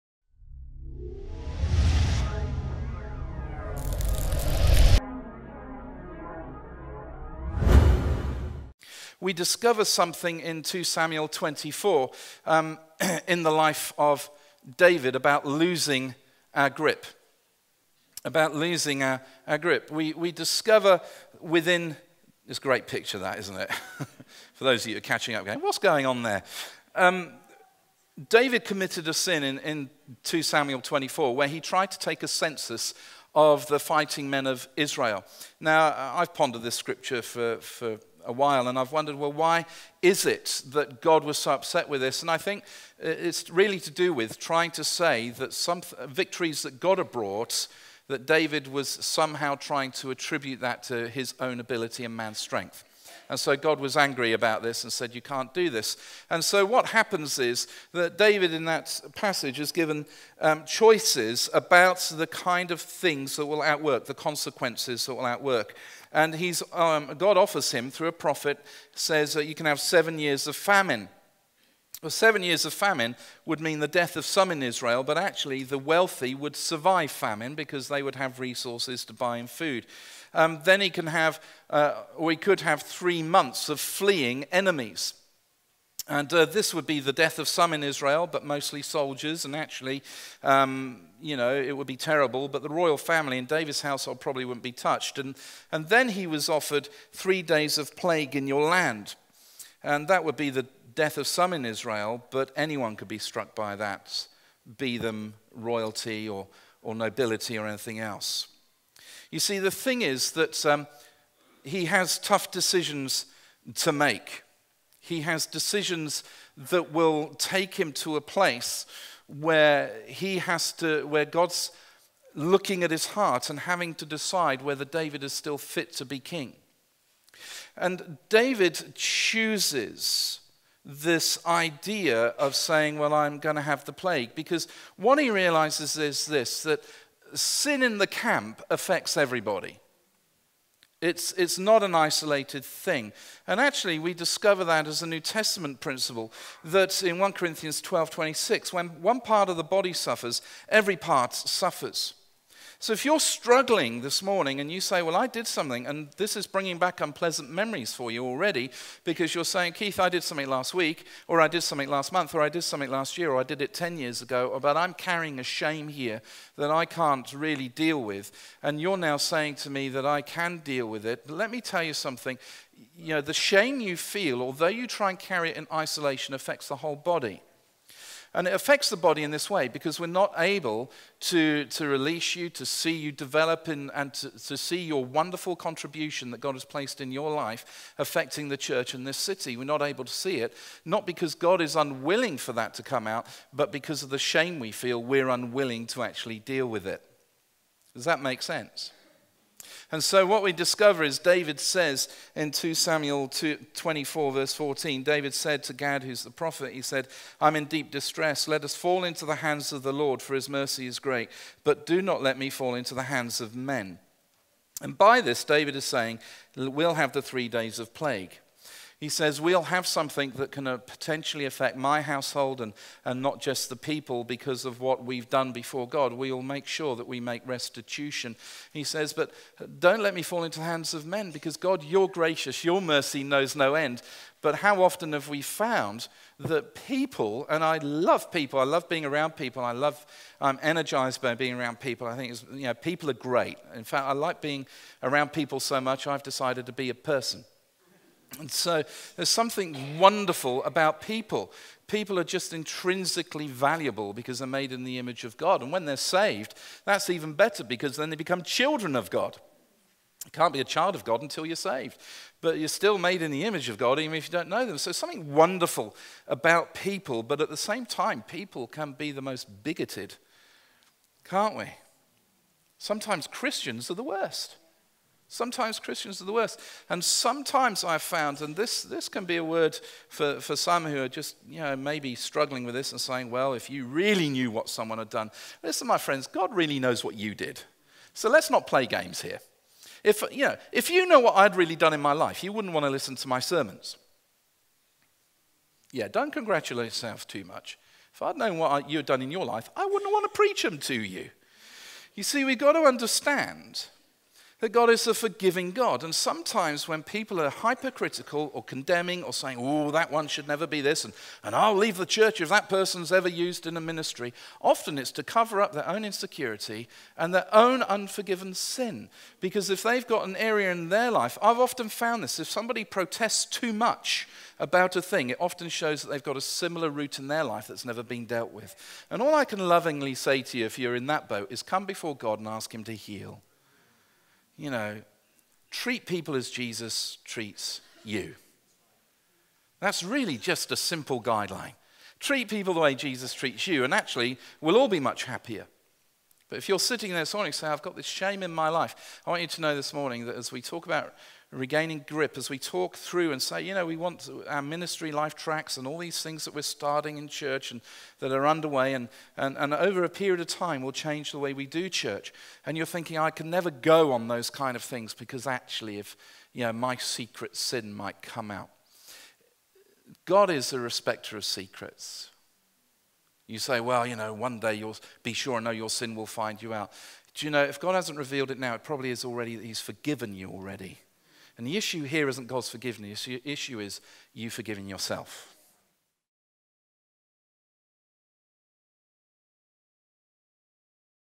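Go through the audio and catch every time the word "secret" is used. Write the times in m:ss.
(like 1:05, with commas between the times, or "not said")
6:06, 6:11.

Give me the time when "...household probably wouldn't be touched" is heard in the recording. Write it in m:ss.
1:33.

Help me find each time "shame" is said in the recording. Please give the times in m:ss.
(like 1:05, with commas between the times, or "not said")
2:45, 2:53, 3:14, 5:48.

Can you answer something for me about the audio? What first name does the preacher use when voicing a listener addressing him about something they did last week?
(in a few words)
Keith.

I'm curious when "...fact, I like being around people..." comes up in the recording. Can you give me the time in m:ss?
4:03.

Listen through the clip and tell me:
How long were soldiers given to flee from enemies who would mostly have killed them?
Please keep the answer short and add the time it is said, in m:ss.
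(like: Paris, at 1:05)
3 months, at 1:22.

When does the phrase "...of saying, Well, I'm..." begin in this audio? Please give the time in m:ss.
2:12.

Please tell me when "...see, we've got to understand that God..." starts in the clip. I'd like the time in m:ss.
5:02.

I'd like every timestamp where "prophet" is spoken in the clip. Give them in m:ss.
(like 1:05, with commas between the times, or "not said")
1:08, 3:26.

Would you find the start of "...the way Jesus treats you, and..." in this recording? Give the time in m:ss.
5:42.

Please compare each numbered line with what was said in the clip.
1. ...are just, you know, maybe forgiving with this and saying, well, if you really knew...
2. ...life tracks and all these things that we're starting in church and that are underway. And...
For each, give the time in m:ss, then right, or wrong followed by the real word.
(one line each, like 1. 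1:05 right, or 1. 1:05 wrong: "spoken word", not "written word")
1. 4:41 wrong: "struggling", not "forgiving"
2. 5:55 right.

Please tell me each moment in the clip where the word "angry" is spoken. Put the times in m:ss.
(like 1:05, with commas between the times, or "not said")
0:53.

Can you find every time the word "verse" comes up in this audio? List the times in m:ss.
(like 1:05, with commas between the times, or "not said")
3:24.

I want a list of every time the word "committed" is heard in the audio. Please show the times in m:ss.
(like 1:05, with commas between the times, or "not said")
0:28.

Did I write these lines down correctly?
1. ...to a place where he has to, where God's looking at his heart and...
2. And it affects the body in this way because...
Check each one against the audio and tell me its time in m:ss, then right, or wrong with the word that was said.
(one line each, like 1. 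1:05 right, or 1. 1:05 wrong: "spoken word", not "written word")
1. 1:57 right
2. 2:58 right.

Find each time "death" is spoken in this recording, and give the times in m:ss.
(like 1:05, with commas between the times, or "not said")
1:13, 1:27, 1:40.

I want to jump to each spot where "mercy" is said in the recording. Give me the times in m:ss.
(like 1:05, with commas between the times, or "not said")
3:30, 3:52.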